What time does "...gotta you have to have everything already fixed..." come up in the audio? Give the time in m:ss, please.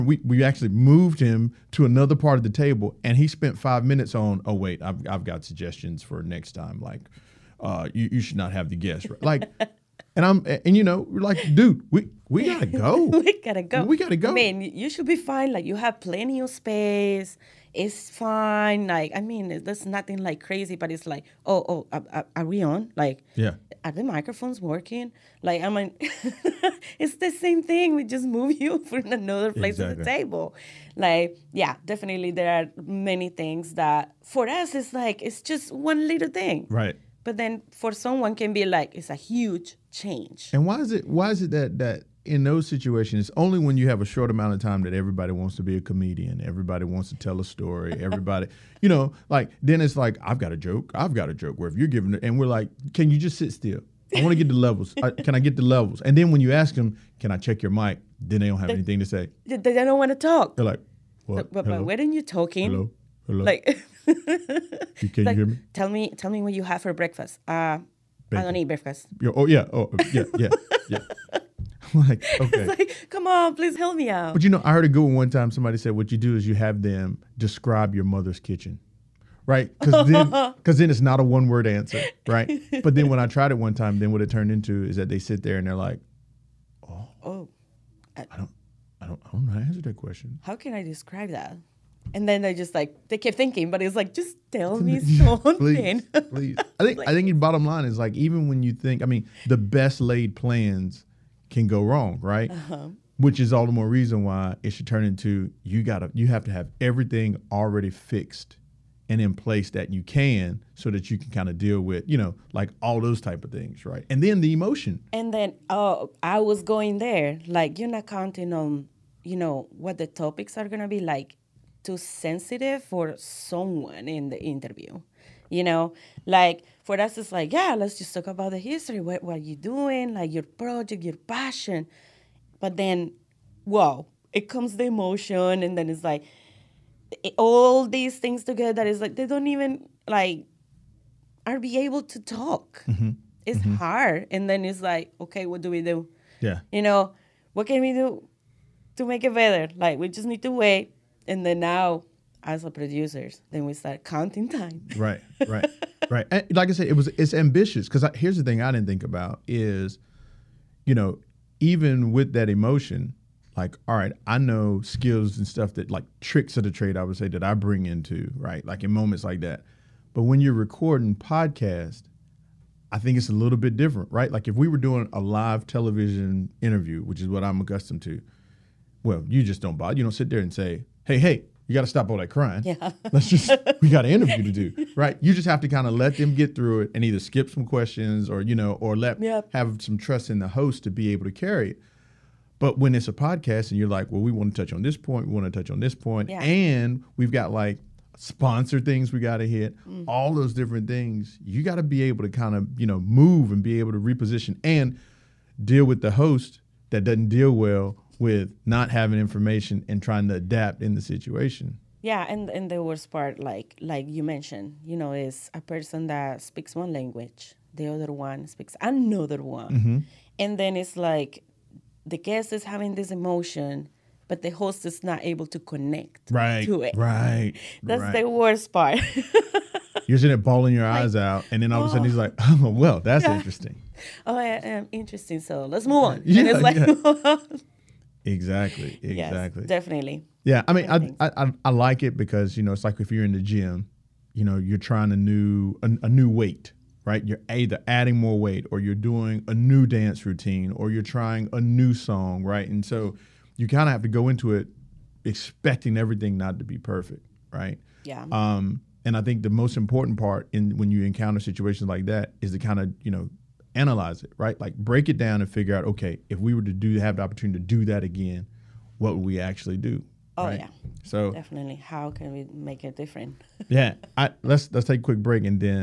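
1:45.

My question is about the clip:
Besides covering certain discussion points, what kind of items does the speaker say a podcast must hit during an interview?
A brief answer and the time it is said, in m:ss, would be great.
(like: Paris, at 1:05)
Sponsor things, at 3:18.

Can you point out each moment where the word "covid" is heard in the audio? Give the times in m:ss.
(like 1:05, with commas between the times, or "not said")
not said.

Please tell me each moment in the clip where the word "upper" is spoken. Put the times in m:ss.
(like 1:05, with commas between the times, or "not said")
not said.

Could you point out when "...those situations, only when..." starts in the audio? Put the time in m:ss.
0:42.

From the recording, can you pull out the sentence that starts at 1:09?
You're, oh yeah, oh yeah, yeah, yeah.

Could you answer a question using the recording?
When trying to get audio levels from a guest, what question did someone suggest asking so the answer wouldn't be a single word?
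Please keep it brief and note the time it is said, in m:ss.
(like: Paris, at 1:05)
Describe your mother's kitchen, at 1:17.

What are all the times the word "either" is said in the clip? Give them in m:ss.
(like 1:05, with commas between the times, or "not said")
3:07, 4:07.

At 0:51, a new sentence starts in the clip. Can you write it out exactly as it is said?
Where if you're giving it, and we're like, can you just sit still?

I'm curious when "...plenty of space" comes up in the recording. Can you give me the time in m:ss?
0:16.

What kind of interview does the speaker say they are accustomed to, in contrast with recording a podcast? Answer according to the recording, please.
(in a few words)
Live television interview.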